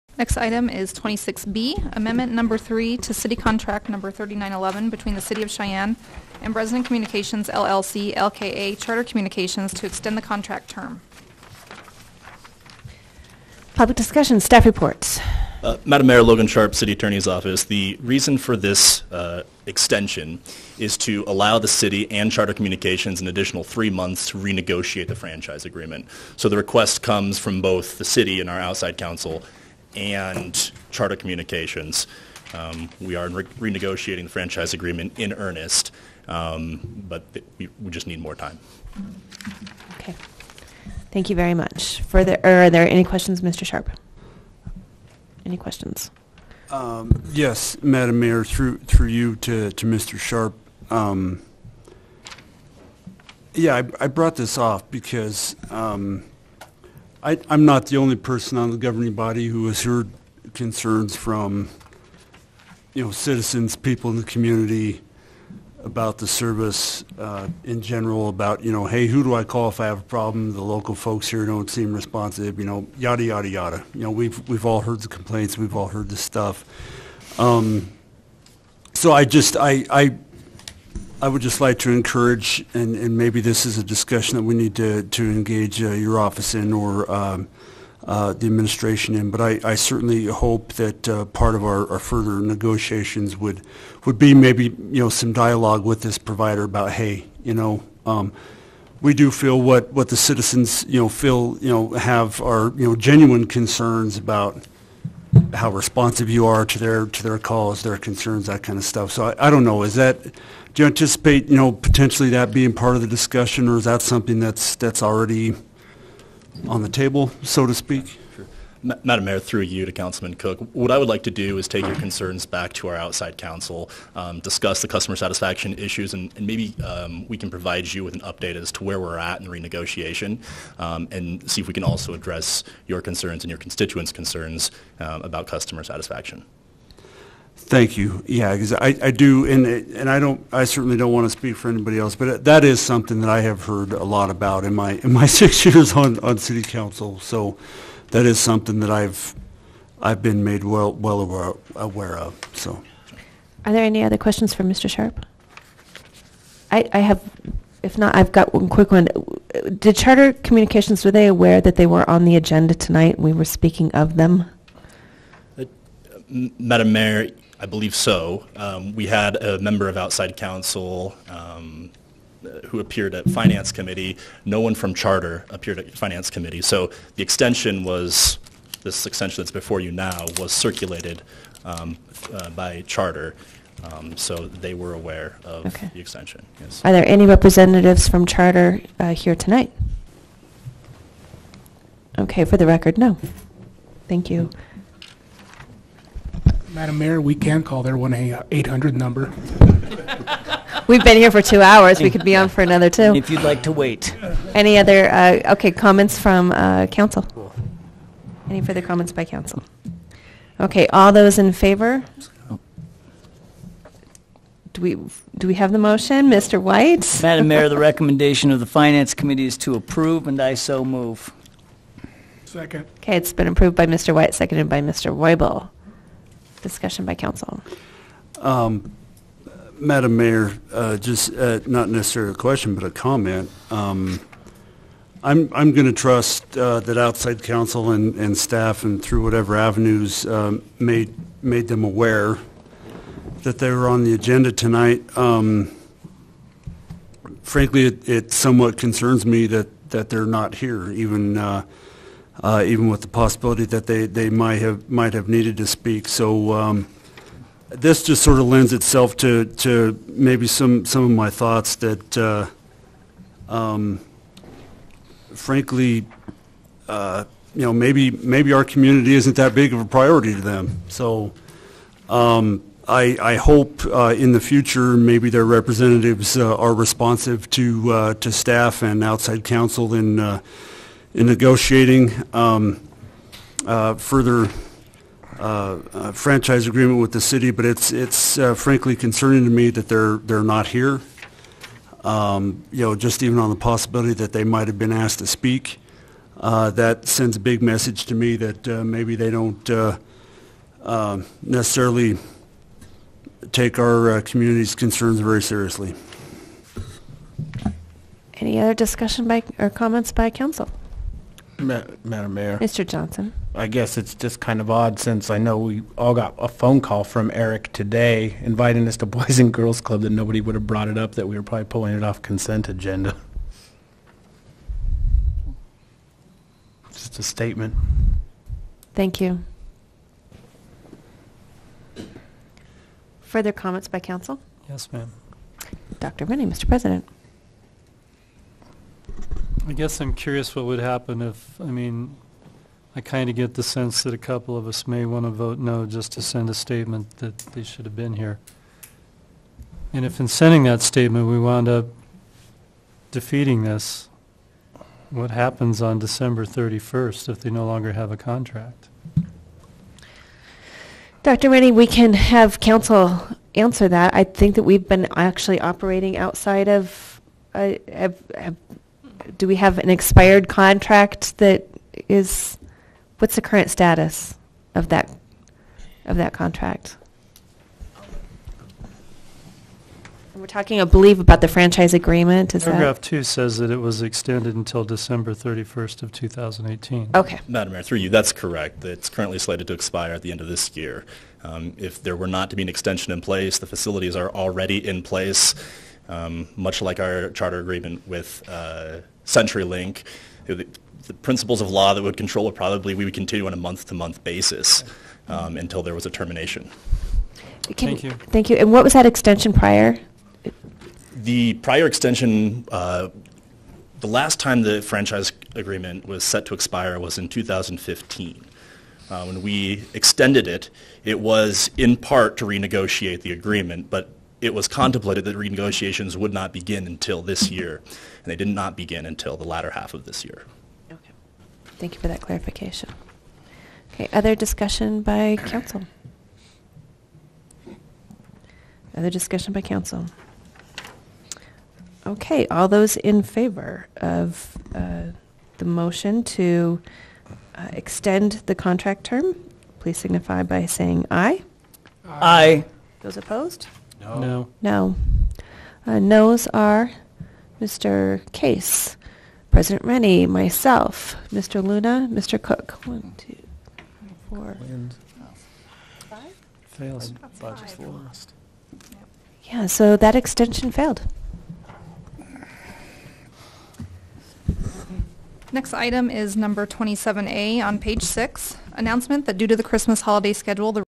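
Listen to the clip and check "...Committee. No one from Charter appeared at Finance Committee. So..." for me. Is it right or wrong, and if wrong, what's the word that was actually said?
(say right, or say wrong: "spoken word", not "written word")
right.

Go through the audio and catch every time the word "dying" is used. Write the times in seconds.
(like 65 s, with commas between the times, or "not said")
not said.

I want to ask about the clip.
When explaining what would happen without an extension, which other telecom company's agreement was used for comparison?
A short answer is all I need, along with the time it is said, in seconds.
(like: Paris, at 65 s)
CenturyLink, at 399 s.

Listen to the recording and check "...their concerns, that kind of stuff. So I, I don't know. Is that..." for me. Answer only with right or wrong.
right.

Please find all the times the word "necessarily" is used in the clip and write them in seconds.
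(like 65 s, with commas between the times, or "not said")
231 s, 301 s.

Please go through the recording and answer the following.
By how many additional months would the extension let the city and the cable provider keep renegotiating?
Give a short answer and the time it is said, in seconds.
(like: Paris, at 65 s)
3, at 23 s.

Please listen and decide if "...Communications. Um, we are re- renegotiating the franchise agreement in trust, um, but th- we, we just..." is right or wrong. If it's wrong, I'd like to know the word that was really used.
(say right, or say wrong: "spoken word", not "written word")
wrong: "earnest", not "trust".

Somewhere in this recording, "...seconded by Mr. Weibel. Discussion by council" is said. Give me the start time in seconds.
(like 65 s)
224 s.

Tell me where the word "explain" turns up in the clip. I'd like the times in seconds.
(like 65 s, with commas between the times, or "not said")
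not said.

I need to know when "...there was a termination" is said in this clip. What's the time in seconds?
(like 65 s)
405 s.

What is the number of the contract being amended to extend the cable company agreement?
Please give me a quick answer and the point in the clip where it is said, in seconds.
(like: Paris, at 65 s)
3911, at 4 s.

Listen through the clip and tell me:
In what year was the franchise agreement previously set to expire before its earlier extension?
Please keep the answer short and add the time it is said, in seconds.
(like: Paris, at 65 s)
2015, at 417 s.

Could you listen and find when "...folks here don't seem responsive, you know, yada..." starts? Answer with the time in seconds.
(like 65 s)
70 s.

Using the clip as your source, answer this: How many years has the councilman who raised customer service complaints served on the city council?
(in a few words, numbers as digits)
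6.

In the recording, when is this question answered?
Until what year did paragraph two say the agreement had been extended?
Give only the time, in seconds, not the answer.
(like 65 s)
386 s.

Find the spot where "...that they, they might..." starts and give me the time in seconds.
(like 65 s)
253 s.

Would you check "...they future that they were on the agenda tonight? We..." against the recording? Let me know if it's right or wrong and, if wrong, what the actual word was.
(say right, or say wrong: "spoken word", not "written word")
wrong: "aware", not "future".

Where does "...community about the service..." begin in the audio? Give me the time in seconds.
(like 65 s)
64 s.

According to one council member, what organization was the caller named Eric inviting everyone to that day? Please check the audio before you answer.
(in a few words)
Boys and Girls Club.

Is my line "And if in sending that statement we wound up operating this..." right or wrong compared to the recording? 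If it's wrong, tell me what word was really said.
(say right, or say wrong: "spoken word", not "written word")
wrong: "defeating", not "operating".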